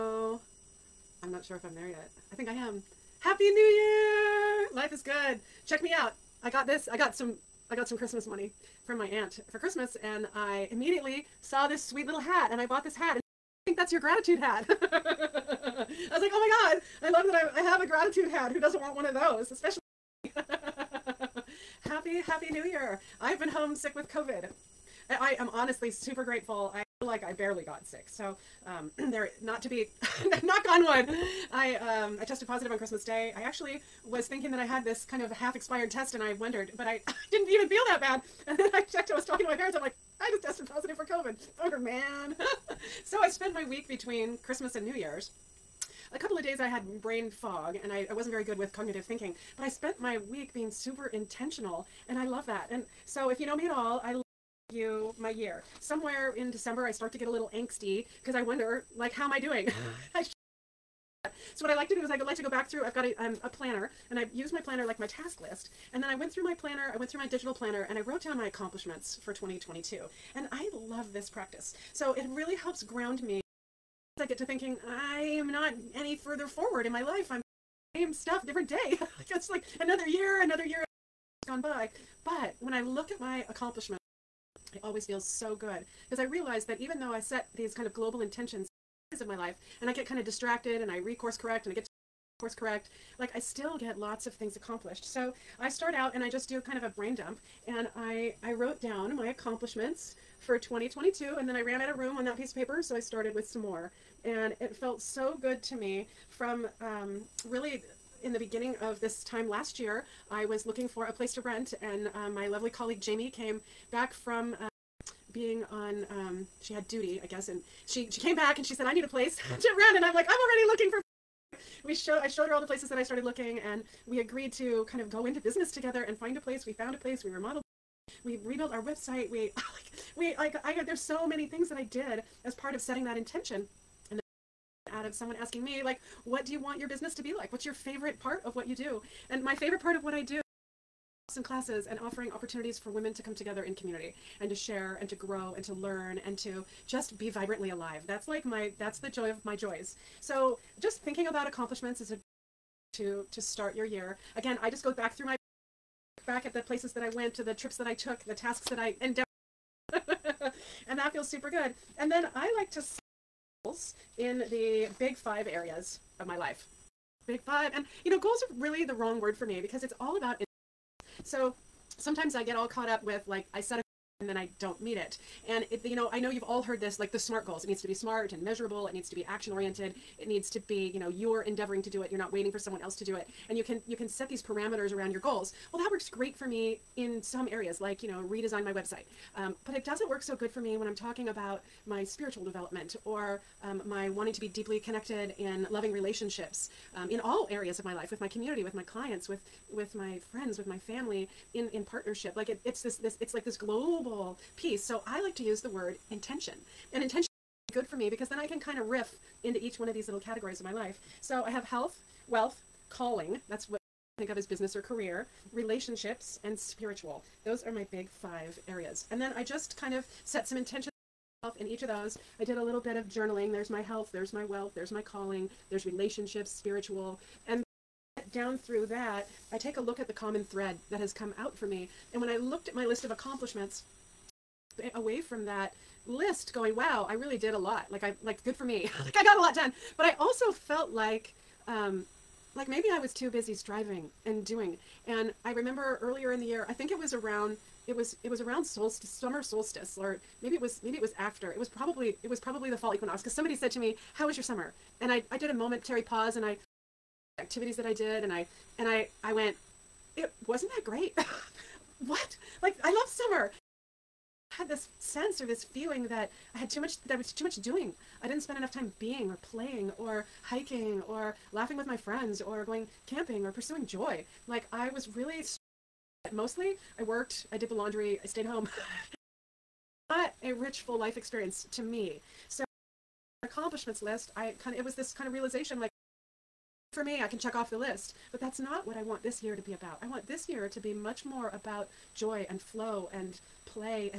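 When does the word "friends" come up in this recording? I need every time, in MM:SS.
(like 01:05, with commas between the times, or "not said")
03:20, 04:31.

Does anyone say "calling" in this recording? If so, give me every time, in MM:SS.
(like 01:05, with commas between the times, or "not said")
03:32, 03:45.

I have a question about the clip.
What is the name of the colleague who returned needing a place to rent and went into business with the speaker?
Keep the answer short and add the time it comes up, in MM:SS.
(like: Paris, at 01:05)
Jamie, at 01:53.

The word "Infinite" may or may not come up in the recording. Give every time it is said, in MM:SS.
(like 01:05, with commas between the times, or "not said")
not said.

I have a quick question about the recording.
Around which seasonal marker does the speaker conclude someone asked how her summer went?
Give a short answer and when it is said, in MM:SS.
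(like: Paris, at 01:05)
Fall equinox, at 04:12.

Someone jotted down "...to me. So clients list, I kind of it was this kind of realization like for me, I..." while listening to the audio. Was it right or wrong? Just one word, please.
wrong.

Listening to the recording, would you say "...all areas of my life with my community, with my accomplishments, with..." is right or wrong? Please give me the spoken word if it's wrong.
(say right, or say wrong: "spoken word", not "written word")
wrong: "clients", not "accomplishments".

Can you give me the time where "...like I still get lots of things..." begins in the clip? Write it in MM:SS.
01:33.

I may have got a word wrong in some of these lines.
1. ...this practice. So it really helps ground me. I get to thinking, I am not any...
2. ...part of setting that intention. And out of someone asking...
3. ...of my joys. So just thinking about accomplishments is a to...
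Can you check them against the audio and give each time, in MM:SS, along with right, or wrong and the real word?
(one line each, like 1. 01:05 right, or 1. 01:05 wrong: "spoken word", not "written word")
1. 01:11 right
2. 02:12 right
3. 02:29 right.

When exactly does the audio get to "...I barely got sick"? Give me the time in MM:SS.
00:27.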